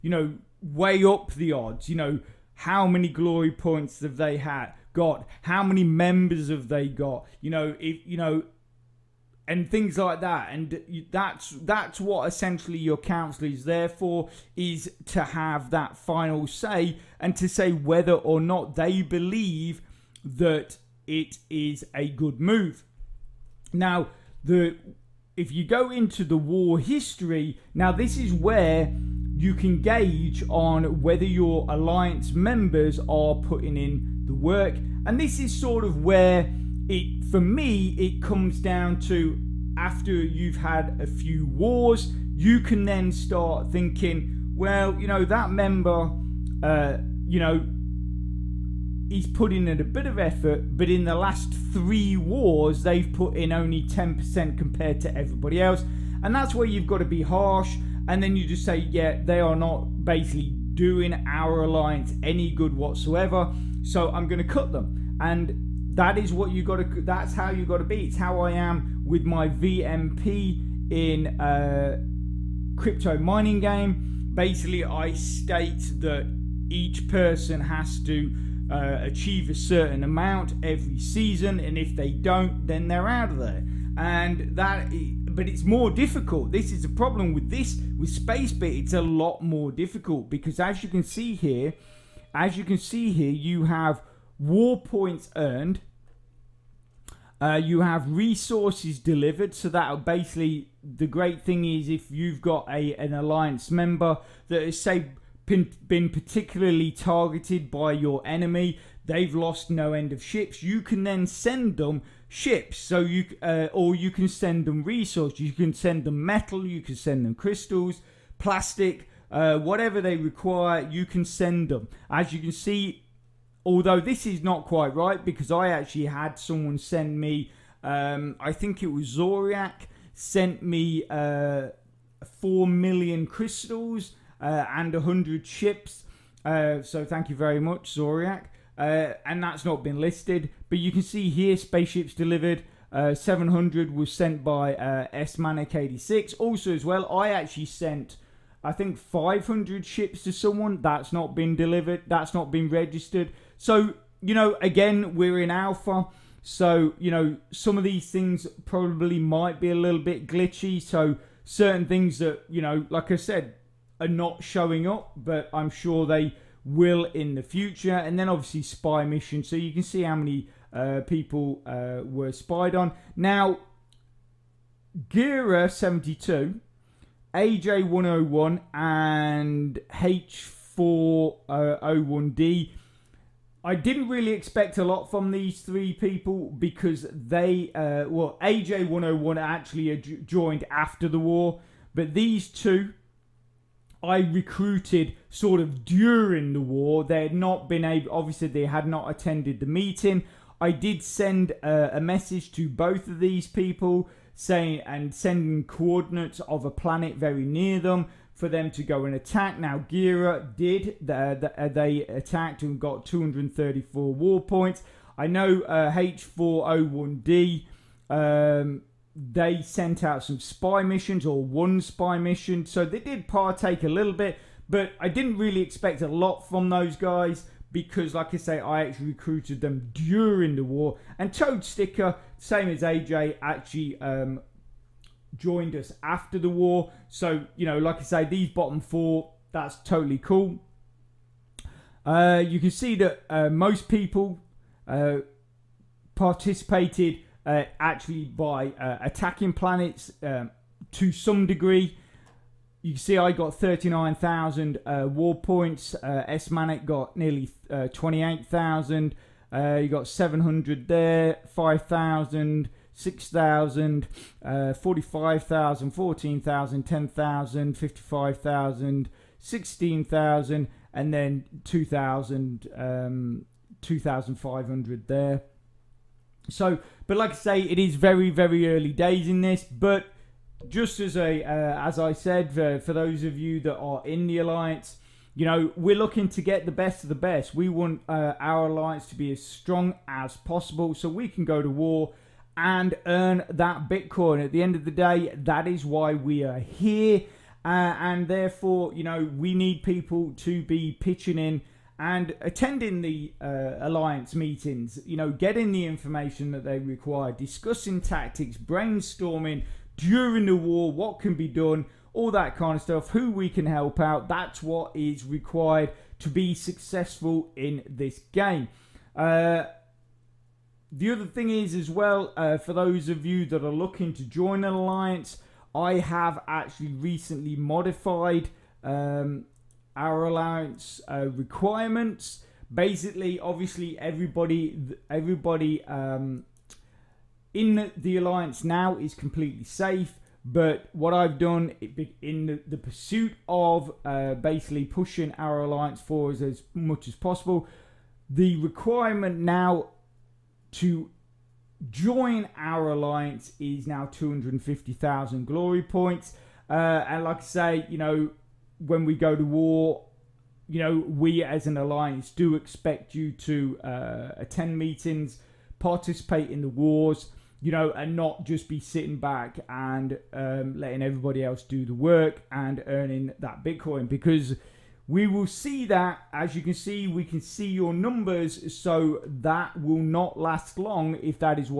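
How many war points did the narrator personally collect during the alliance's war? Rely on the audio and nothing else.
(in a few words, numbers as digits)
39,000.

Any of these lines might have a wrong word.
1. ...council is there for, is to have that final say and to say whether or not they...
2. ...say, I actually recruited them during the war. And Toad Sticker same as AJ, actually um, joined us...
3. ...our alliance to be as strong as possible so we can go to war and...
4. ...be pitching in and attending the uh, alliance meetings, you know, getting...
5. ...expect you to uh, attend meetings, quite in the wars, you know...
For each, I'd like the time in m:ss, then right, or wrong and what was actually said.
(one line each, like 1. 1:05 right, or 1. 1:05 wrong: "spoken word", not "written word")
1. 0:12 right
2. 3:48 right
3. 4:48 right
4. 5:00 right
5. 6:02 wrong: "participate", not "quite".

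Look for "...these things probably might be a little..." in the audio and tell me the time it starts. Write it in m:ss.
2:37.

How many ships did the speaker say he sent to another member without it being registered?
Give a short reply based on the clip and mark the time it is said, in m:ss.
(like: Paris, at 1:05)
500, at 2:28.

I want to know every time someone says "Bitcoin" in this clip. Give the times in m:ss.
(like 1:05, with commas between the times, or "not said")
4:53, 6:13.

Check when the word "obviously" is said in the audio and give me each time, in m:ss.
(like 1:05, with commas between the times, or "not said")
2:48, 3:18, 5:33.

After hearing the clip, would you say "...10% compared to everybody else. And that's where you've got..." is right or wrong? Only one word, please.
right.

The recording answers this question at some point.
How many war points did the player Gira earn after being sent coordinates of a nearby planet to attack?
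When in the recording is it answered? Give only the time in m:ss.
3:33.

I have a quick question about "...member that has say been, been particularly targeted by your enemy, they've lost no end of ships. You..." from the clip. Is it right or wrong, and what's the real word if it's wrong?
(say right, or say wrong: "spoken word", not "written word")
right.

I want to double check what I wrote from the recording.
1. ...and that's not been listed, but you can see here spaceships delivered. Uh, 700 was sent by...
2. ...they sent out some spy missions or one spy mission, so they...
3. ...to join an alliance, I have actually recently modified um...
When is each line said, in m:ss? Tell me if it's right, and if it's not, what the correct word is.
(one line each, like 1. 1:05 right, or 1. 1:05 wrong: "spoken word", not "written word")
1. 2:19 right
2. 3:39 right
3. 5:24 right.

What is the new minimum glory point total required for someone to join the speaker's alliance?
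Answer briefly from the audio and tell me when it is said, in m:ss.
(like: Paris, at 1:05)
250,000, at 5:54.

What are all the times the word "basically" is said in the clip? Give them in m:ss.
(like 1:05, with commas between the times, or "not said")
1:00, 1:14, 1:40, 5:32, 5:44.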